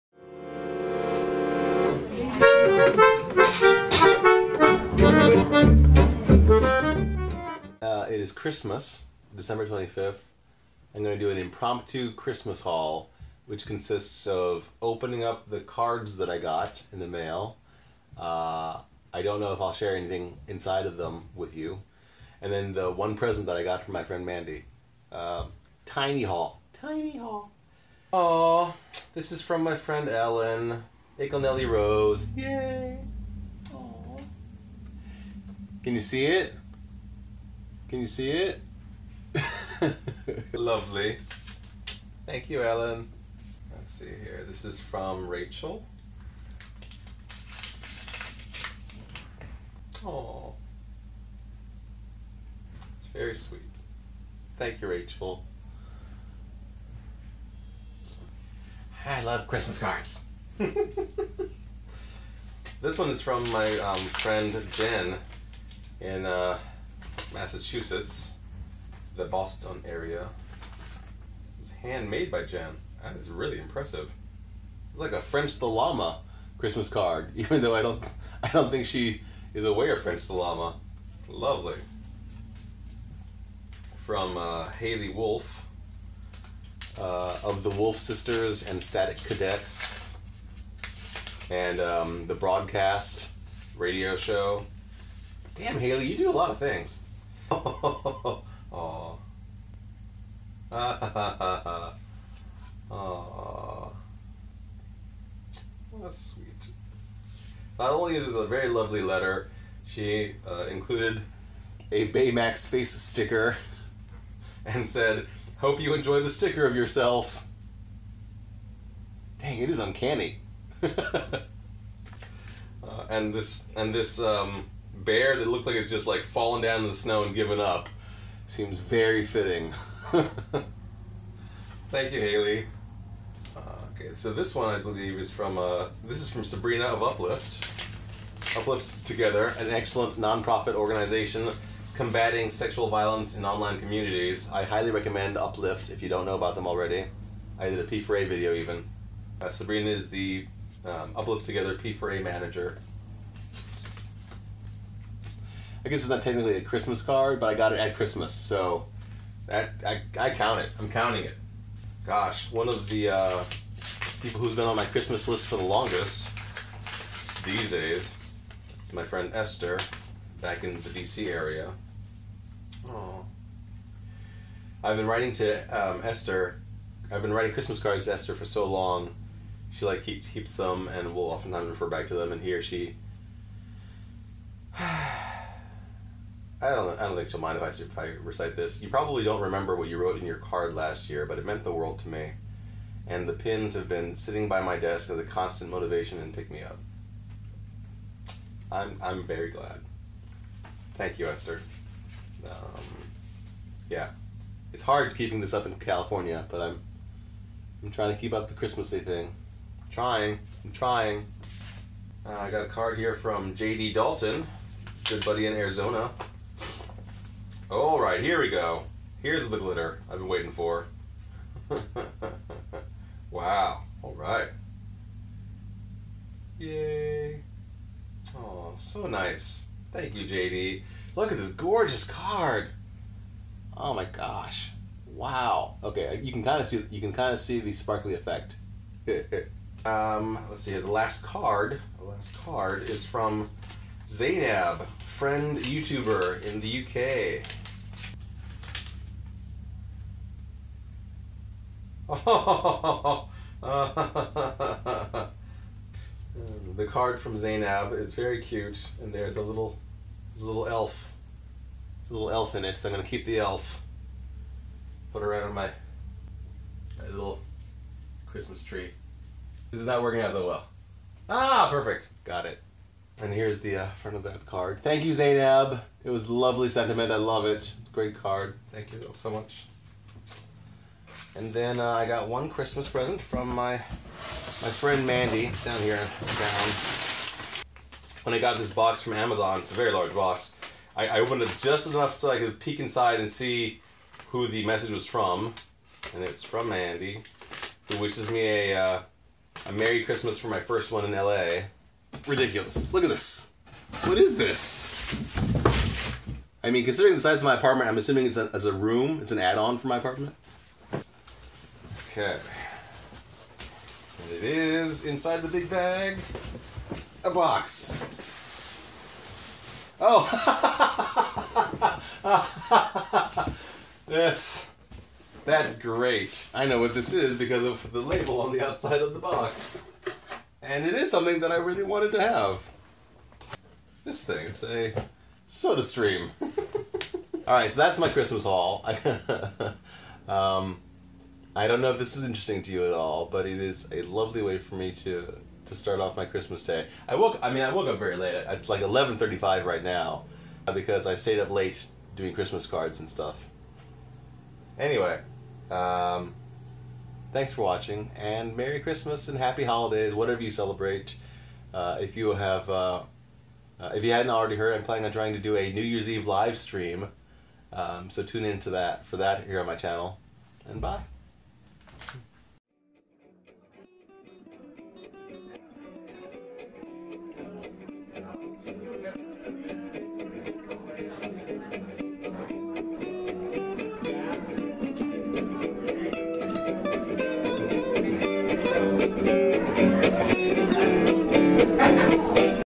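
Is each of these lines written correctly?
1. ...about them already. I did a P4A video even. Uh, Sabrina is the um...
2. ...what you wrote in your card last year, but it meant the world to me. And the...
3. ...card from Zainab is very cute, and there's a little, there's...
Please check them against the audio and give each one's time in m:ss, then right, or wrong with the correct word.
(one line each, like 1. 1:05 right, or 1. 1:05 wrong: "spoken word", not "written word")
1. 2:26 right
2. 3:09 right
3. 4:16 right.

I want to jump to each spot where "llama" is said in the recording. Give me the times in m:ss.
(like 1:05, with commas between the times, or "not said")
1:15, 1:20.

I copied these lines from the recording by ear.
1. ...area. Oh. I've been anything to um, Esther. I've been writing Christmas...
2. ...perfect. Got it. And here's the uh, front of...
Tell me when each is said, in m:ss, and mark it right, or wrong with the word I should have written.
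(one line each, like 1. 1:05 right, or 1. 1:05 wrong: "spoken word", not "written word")
1. 2:51 wrong: "writing", not "anything"
2. 4:31 right.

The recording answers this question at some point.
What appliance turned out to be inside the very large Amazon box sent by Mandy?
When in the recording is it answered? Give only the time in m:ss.
5:35.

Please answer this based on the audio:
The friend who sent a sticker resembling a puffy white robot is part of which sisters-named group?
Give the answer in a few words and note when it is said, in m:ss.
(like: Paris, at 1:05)
Wolf Sisters, at 1:27.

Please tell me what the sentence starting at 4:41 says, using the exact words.
And then uh, I got one Christmas present from my my friend Mandy down here down.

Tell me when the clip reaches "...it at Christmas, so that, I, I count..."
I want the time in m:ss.
2:37.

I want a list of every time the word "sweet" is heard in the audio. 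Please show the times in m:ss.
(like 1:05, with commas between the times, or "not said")
0:53, 1:46.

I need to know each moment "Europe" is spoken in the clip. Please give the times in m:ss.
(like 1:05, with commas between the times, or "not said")
not said.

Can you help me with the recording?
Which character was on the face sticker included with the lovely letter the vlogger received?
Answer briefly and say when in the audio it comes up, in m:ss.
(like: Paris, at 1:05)
Baymax, at 1:52.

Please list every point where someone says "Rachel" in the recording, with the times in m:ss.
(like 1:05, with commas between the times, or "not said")
0:45, 0:54.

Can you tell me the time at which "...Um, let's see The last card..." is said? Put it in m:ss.
3:59.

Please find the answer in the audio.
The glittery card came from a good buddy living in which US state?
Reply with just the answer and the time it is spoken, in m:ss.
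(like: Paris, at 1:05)
Arizona, at 3:35.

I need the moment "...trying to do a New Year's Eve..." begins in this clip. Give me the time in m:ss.
6:05.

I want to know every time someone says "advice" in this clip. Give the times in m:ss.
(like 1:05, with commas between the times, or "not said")
not said.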